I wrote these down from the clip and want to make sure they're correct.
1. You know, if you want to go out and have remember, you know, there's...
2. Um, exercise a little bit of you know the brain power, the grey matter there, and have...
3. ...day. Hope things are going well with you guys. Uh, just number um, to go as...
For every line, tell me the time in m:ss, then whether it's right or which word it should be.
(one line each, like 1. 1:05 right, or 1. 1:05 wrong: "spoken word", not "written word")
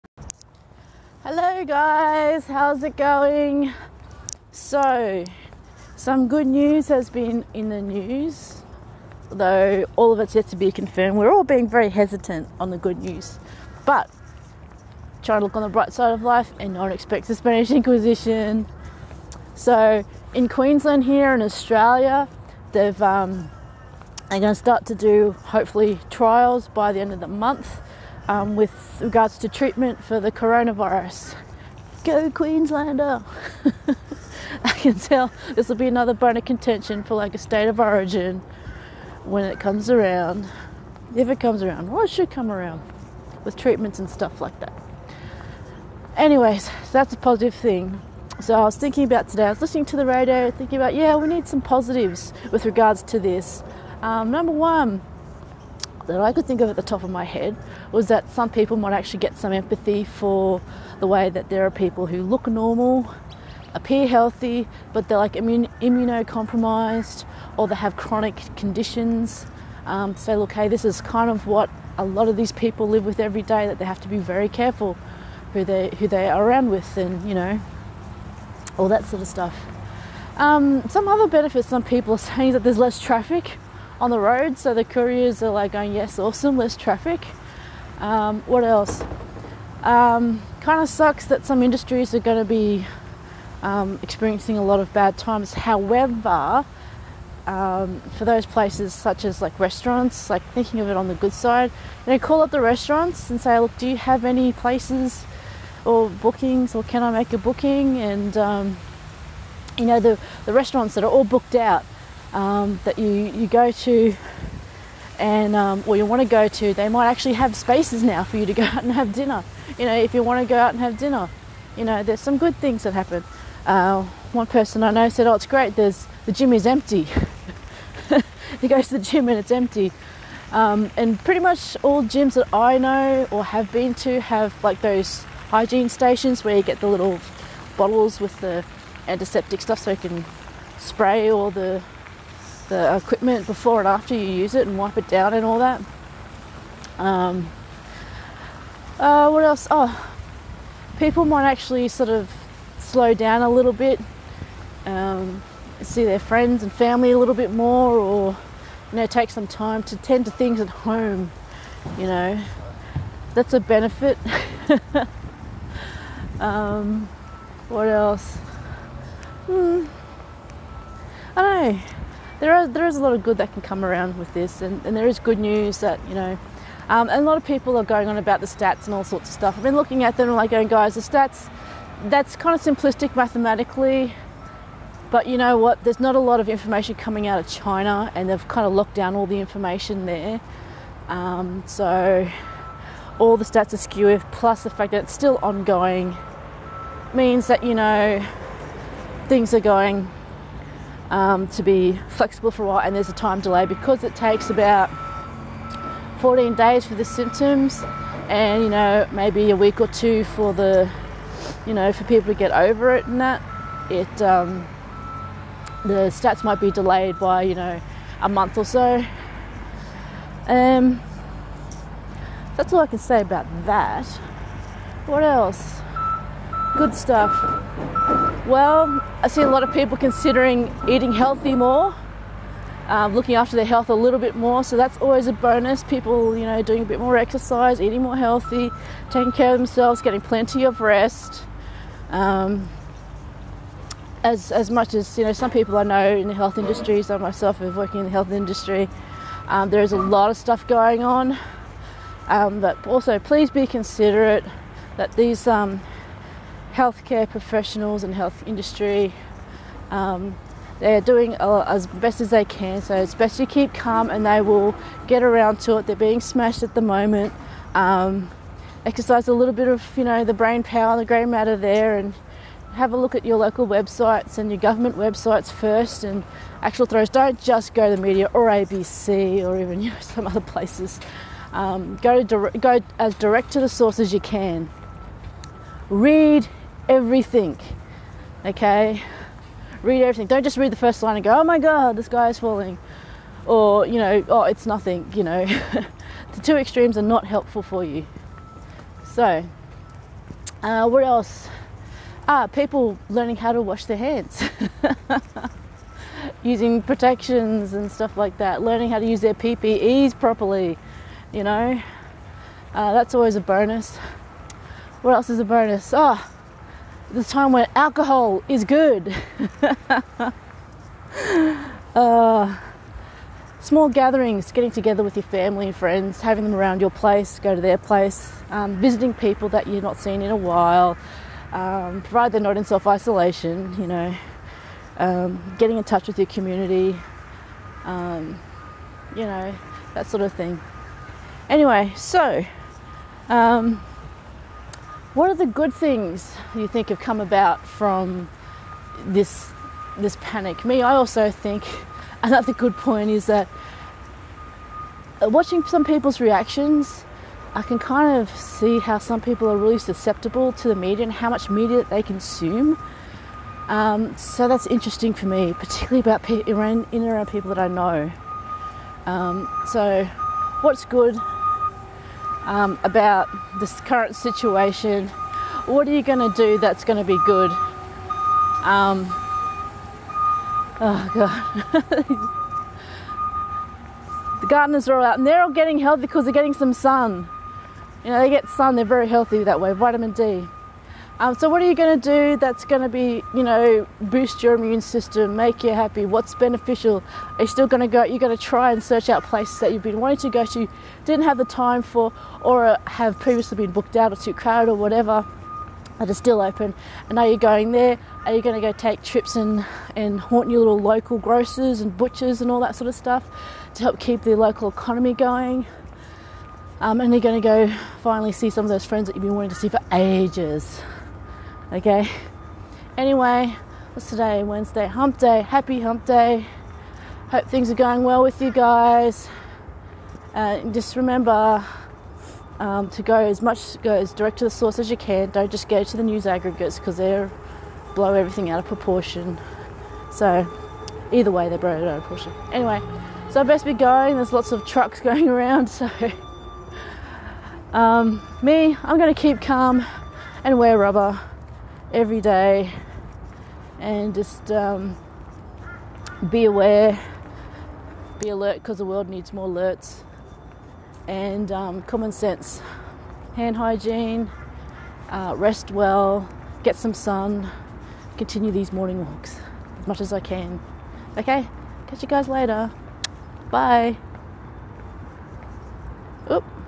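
1. 1:59 wrong: "dinner", not "remember"
2. 4:27 right
3. 7:06 wrong: "remember", not "number".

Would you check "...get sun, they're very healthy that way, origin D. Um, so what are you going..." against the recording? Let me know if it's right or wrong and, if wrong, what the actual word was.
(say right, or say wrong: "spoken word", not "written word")
wrong: "vitamin", not "origin".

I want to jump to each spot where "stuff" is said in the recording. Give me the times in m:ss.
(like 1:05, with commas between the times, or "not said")
0:44, 1:19, 2:19, 2:59, 3:46, 4:10, 5:07, 6:52.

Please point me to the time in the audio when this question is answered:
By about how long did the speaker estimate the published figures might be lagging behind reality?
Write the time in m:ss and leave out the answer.
3:38.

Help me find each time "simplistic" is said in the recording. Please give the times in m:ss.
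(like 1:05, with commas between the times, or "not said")
3:02.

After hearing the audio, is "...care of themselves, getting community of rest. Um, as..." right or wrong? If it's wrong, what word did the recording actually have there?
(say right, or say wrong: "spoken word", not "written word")
wrong: "plenty", not "community".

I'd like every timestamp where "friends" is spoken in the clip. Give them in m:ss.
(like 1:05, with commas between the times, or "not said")
2:36, 5:25, 6:58.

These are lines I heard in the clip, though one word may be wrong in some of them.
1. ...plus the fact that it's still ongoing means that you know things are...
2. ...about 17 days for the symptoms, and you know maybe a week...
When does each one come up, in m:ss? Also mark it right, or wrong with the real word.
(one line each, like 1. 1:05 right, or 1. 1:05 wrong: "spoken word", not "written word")
1. 3:14 right
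2. 3:24 wrong: "14", not "17".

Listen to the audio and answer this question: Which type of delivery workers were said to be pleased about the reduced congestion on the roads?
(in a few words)
Couriers.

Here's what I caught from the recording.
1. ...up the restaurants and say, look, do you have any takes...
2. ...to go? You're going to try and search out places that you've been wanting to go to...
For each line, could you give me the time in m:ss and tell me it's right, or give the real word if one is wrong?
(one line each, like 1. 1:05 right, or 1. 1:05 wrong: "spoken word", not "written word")
1. 1:42 wrong: "places", not "takes"
2. 6:37 right.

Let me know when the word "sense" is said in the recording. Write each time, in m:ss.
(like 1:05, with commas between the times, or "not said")
7:42.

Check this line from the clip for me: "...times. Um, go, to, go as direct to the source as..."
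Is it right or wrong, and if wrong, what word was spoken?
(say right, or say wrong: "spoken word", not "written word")
wrong: "places", not "times".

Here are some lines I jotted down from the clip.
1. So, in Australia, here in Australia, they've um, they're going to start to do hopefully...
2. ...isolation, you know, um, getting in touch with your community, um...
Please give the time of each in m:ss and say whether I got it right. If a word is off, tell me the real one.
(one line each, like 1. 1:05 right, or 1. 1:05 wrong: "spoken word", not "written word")
1. 0:19 wrong: "Queensland", not "Australia"
2. 5:32 right.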